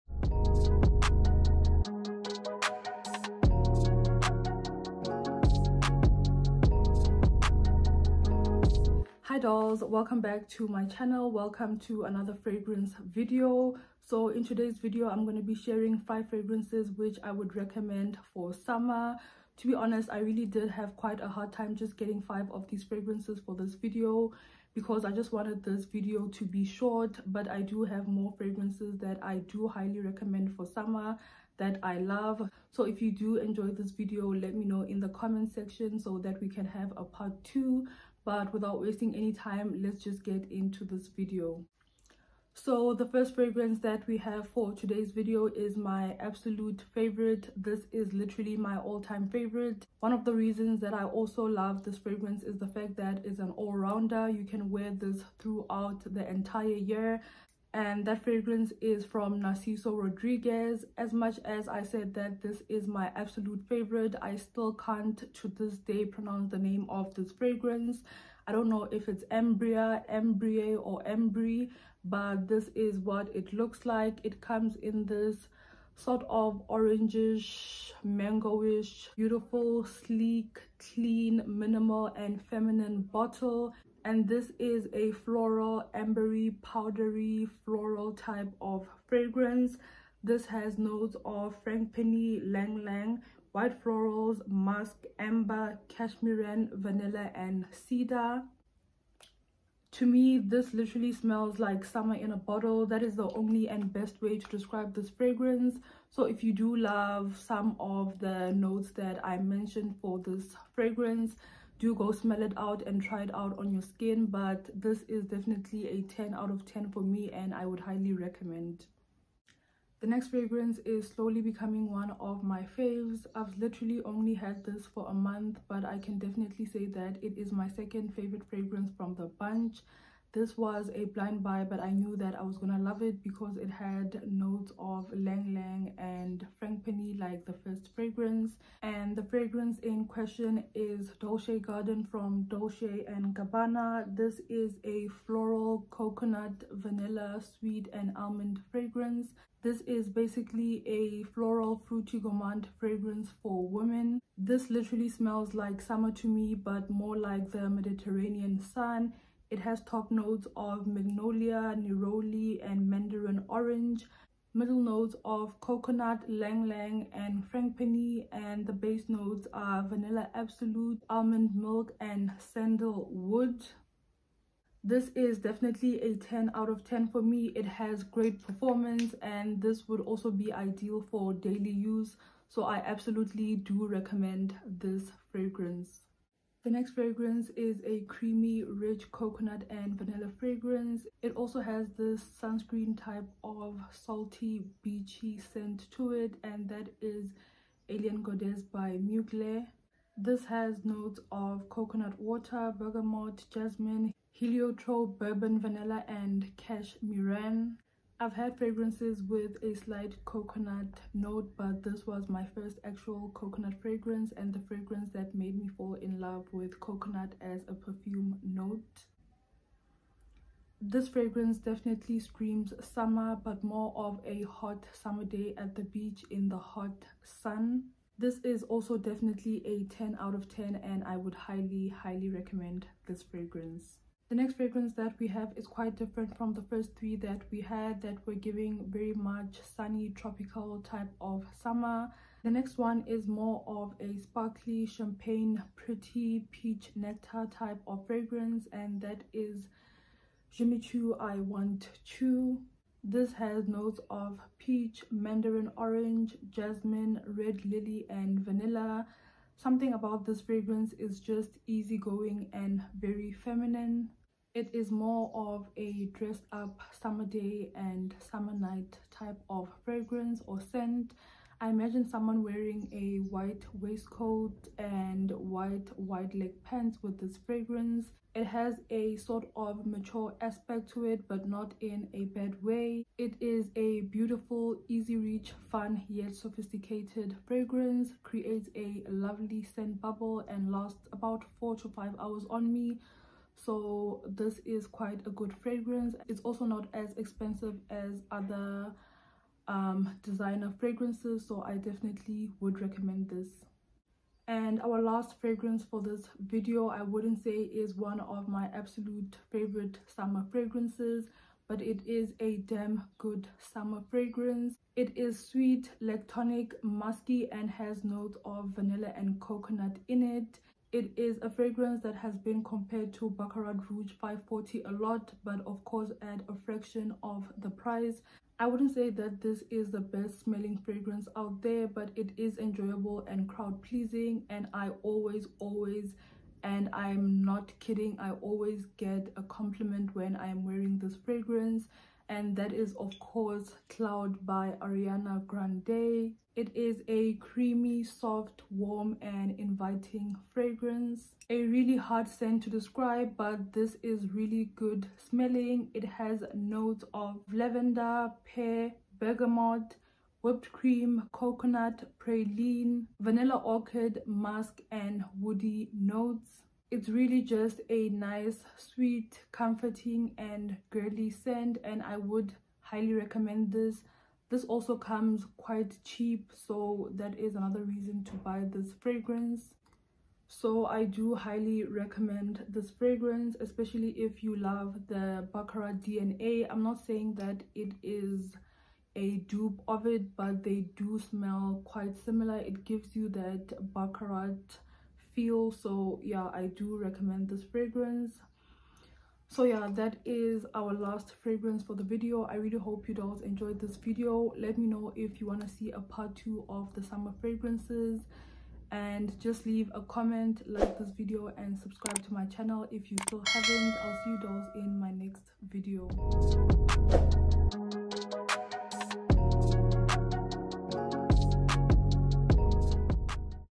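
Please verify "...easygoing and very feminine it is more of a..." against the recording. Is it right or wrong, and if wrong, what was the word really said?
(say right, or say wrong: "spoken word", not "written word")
right.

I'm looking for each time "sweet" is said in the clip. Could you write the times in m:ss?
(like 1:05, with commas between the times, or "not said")
2:27, 5:15, 6:08.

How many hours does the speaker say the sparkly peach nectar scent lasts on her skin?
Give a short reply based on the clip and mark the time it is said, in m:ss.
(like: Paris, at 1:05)
4 to 5 hours, at 4:51.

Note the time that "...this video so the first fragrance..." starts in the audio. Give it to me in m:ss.
0:40.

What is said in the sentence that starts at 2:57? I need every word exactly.
It has great performance and this would also be ideal for daily use.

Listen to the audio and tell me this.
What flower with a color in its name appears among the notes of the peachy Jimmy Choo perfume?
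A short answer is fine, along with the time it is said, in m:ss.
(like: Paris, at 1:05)
red lily, at 4:17.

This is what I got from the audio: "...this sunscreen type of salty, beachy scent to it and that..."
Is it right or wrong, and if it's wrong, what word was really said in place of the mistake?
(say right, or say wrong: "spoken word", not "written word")
right.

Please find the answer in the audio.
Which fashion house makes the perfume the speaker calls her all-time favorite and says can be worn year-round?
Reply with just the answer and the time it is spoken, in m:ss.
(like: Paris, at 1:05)
Narciso Rodriguez, at 0:59.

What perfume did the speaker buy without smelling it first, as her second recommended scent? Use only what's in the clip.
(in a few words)
Dolce Garden.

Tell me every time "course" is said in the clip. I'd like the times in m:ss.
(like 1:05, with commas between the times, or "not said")
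5:25, 5:43.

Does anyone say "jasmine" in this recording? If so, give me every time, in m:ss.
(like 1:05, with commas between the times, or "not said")
3:23, 4:16.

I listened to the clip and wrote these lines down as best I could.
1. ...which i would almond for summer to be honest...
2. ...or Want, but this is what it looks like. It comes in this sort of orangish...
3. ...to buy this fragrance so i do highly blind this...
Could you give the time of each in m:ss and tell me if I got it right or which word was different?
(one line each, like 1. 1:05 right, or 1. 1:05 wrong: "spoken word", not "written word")
1. 0:16 wrong: "recommend", not "almond"
2. 1:10 wrong: "Embry", not "Want"
3. 6:18 wrong: "recommend", not "blind".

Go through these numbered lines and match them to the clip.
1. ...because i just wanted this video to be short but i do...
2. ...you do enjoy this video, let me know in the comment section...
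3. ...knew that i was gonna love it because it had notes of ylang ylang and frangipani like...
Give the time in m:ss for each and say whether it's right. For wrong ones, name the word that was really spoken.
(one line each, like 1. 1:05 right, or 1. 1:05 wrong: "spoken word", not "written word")
1. 0:24 right
2. 0:33 right
3. 2:11 right.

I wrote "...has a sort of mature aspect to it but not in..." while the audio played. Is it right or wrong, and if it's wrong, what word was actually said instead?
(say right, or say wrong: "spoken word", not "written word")
right.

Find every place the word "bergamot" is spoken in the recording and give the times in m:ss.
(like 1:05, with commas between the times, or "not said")
3:22, 5:59.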